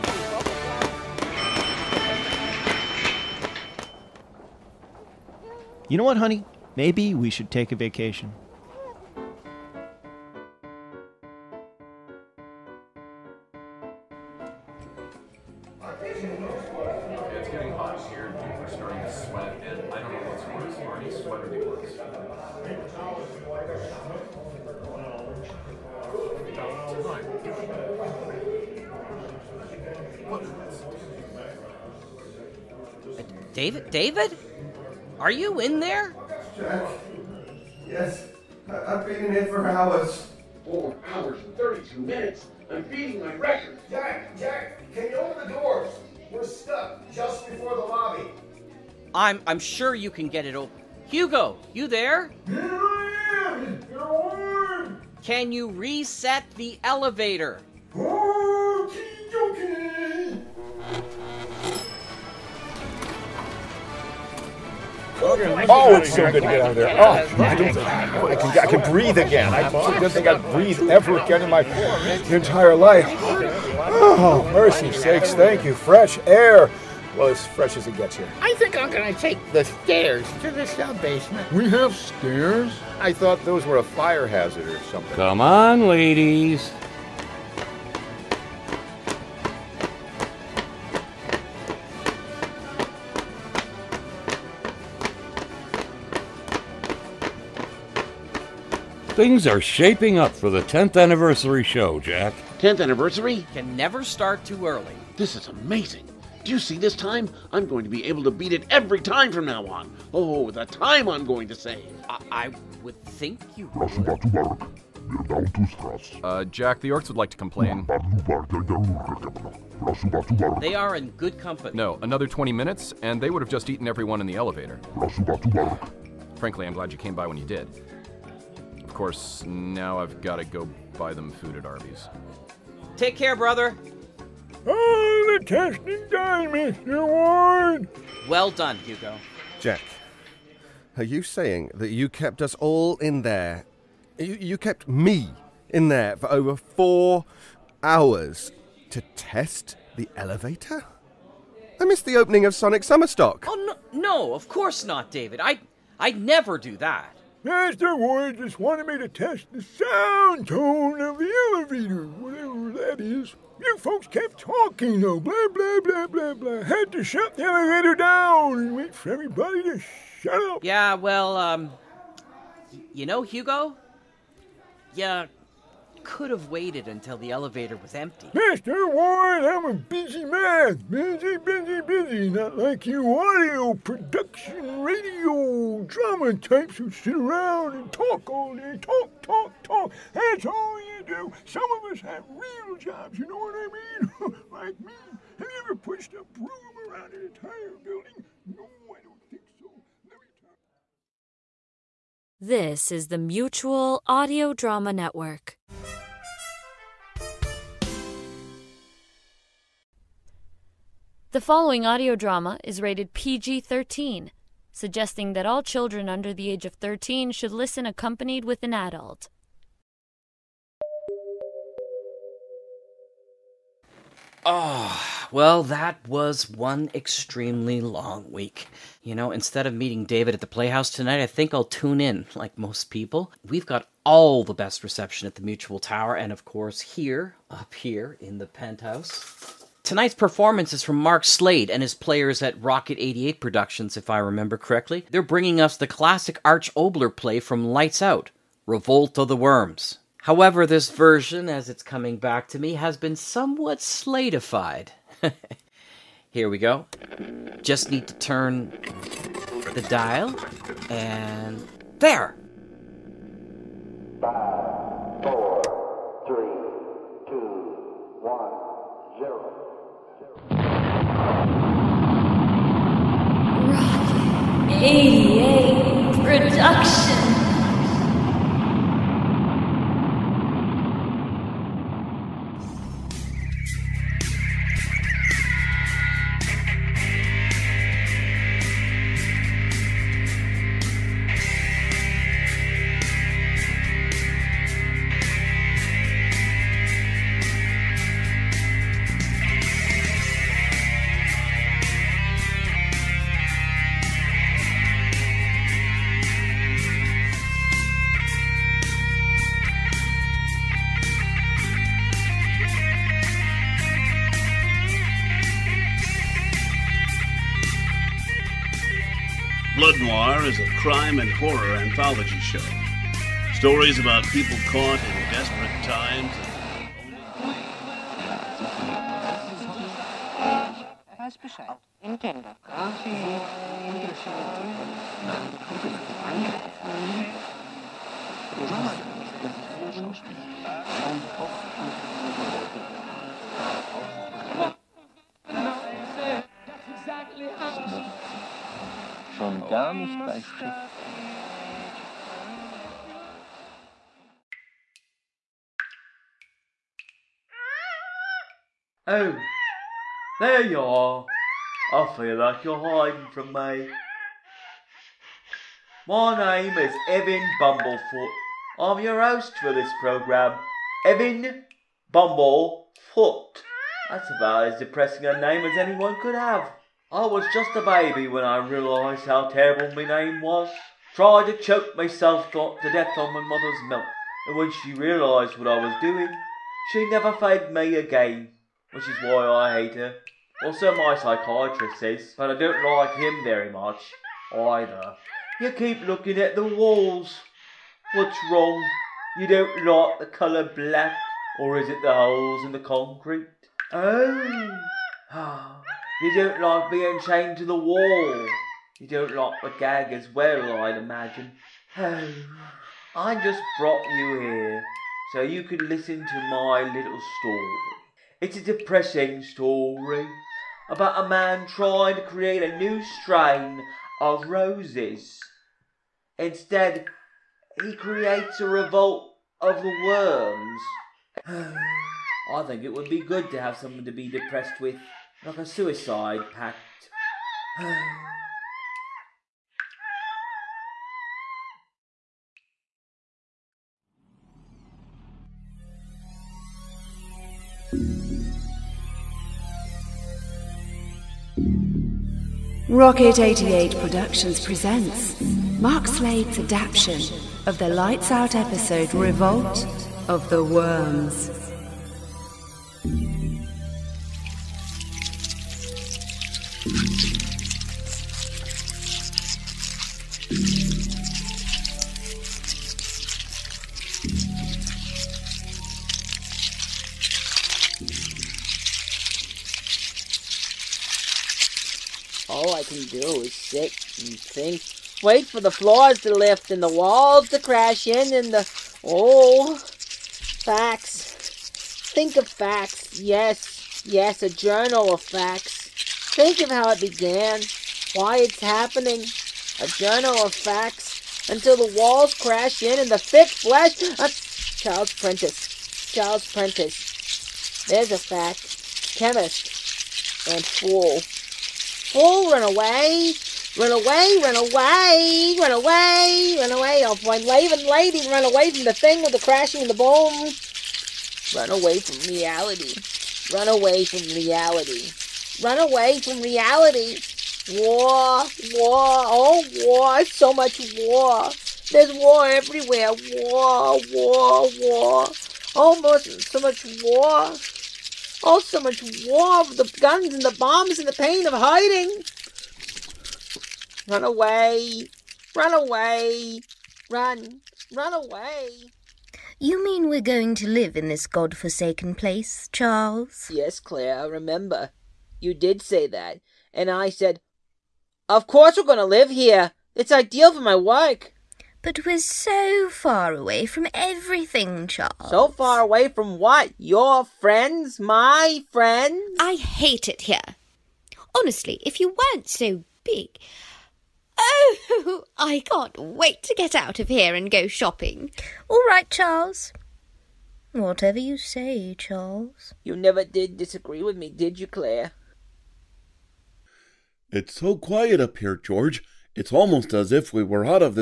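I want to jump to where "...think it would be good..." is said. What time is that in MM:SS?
07:12.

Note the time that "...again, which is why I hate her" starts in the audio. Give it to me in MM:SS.
06:27.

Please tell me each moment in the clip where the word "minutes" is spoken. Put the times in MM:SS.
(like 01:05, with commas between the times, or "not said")
00:41, 02:02.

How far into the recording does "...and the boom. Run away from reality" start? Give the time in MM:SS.
08:39.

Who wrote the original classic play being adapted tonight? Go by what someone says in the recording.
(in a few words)
Arch Oboler.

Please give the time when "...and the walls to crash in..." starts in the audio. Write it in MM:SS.
08:06.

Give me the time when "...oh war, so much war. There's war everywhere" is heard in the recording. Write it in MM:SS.
08:49.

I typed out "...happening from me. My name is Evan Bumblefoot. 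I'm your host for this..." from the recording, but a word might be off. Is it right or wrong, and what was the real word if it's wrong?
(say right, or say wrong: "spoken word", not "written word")
wrong: "hiding", not "happening".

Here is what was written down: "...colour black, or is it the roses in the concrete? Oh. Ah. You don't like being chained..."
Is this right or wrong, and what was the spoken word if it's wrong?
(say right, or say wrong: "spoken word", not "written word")
wrong: "holes", not "roses".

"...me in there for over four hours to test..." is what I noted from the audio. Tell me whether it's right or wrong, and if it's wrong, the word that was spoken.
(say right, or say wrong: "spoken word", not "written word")
right.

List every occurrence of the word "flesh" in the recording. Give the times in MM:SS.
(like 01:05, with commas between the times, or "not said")
08:23.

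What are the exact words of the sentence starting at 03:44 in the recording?
Oh, well, that was one extremely long week.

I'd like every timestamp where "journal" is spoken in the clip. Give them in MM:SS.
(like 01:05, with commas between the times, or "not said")
08:14, 08:19.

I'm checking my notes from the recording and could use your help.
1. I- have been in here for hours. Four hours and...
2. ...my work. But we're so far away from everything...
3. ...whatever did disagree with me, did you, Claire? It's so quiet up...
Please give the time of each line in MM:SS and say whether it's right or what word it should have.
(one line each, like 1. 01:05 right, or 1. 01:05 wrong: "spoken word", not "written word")
1. 00:38 right
2. 09:20 right
3. 09:42 wrong: "never", not "whatever".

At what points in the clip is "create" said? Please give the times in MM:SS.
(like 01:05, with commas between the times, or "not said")
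07:02, 07:07.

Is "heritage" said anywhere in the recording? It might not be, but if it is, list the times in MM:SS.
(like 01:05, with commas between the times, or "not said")
not said.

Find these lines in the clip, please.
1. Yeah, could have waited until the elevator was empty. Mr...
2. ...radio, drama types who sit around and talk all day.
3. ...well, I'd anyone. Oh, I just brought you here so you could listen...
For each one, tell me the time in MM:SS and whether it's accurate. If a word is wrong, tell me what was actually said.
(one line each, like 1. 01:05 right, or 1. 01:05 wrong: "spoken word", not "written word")
1. 02:54 right
2. 03:04 right
3. 06:50 wrong: "imagine", not "anyone".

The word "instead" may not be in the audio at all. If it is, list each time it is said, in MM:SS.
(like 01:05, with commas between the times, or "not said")
03:49, 07:06.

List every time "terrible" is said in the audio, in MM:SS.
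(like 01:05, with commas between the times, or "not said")
06:19.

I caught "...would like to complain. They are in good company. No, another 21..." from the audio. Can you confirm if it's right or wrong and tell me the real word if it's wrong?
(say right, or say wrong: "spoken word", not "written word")
wrong: "20", not "21".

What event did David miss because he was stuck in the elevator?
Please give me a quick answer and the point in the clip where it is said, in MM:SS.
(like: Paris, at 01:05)
Sonic Summerstock, at 02:32.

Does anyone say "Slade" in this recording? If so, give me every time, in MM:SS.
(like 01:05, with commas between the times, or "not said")
04:01, 07:36.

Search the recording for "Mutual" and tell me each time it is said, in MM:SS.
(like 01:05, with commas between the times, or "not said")
03:23, 03:55.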